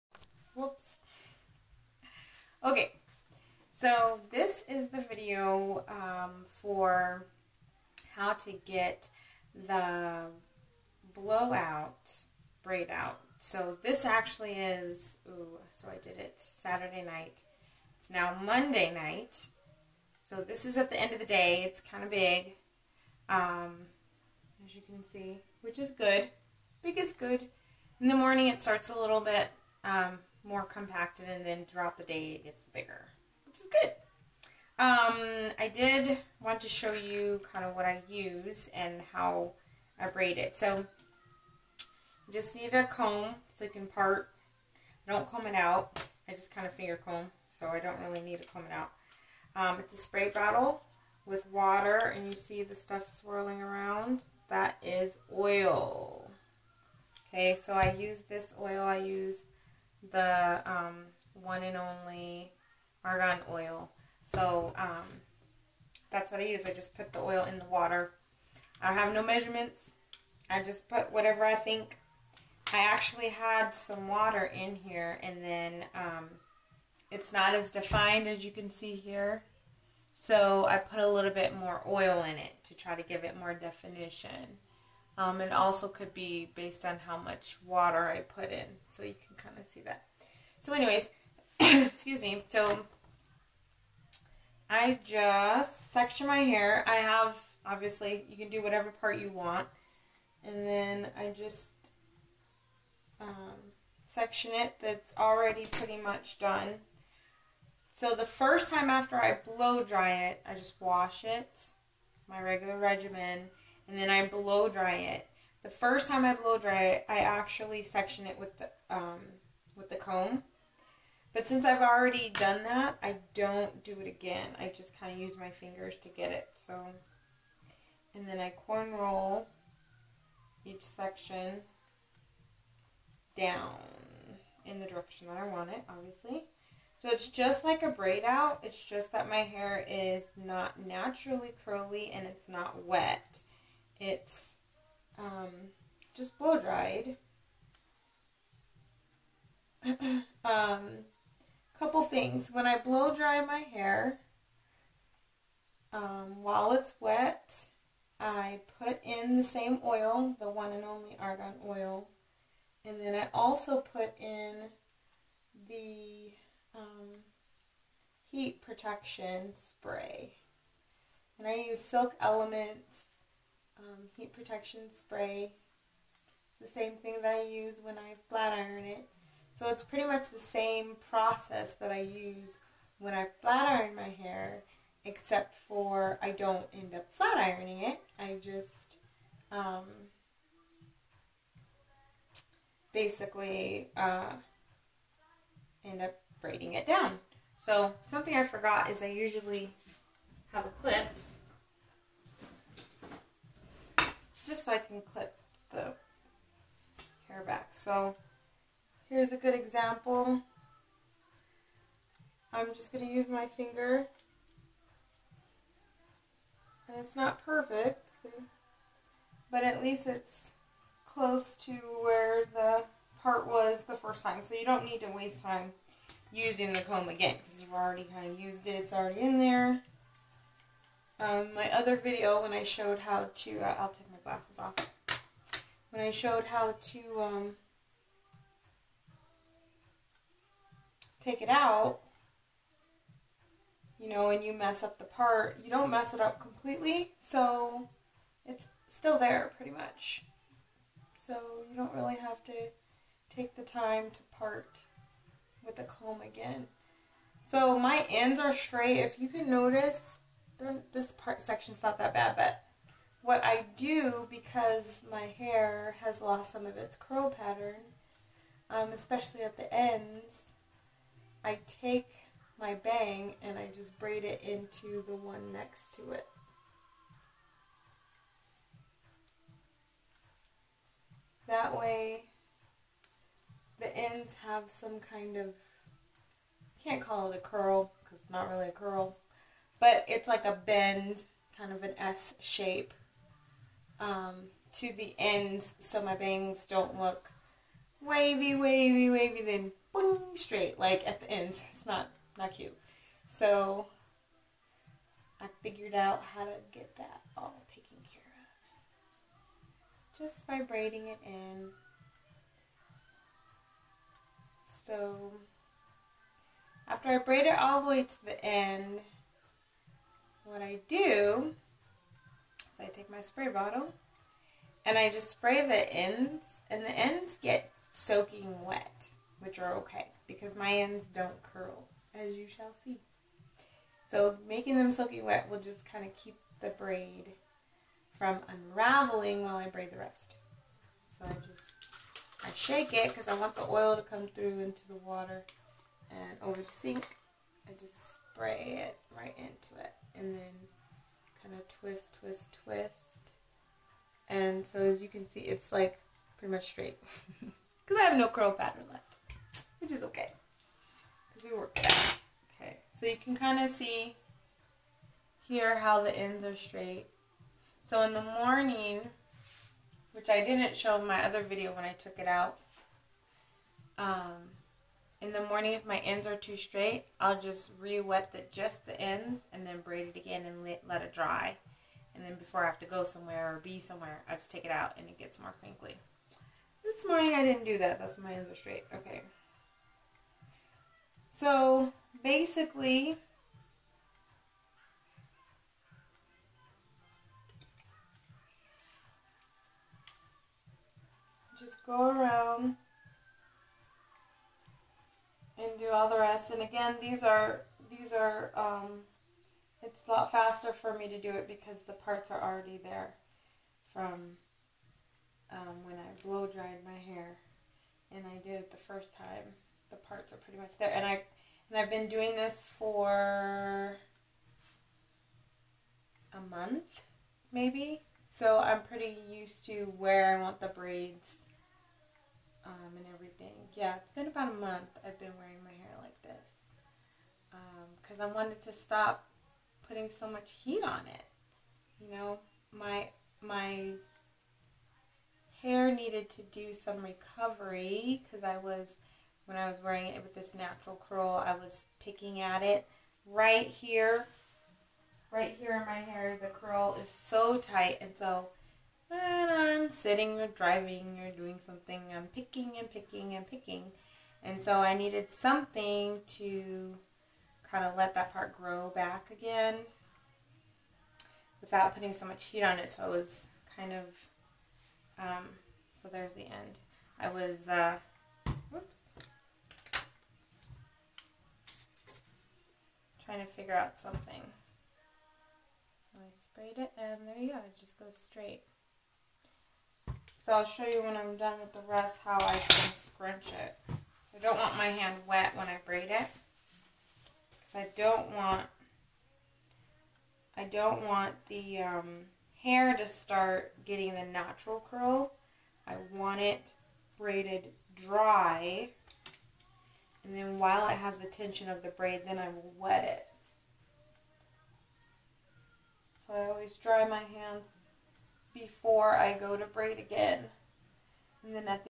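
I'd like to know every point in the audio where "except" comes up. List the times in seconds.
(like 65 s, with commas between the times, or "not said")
185 s.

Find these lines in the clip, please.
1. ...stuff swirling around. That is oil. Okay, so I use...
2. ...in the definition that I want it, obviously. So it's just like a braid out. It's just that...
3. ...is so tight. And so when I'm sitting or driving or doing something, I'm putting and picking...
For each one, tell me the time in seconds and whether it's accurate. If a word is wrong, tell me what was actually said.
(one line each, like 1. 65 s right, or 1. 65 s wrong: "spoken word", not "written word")
1. 52 s right
2. 134 s wrong: "direction", not "definition"
3. 457 s wrong: "picking", not "putting".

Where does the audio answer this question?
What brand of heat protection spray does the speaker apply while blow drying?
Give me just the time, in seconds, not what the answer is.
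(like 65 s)
171 s.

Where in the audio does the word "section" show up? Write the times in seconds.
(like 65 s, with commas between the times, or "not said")
95 s, 104 s, 117 s, 130 s, 261 s.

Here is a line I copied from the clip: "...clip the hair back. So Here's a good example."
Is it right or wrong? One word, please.
right.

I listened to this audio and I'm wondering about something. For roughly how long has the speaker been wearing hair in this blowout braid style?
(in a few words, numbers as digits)
about a month.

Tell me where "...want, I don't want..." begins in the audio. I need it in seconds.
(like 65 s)
498 s.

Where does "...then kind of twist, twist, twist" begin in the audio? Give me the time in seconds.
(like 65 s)
350 s.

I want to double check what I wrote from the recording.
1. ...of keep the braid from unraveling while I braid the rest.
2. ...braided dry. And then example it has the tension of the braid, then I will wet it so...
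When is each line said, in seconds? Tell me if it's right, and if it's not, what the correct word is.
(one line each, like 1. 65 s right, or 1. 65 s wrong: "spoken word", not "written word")
1. 336 s right
2. 507 s wrong: "while", not "example".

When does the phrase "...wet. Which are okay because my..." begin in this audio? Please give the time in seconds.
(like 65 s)
328 s.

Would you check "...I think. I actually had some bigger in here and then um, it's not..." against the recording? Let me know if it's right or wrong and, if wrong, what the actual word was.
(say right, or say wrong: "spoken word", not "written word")
wrong: "water", not "bigger".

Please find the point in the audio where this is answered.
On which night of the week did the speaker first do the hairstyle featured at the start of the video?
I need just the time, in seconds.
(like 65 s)
16 s.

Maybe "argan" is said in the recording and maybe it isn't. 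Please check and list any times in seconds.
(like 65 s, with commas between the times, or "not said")
63 s, 161 s.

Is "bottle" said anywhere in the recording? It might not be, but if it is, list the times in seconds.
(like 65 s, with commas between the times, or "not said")
50 s, 323 s.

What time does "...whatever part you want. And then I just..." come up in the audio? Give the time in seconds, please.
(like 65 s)
98 s.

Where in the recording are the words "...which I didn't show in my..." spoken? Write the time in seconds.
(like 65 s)
370 s.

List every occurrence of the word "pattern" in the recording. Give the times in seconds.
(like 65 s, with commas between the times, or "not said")
267 s, 358 s.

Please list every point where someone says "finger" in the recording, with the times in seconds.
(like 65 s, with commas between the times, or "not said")
46 s, 125 s, 213 s.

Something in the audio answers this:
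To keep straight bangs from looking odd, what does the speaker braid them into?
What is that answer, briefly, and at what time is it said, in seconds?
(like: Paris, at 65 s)
the one next to it, at 275 s.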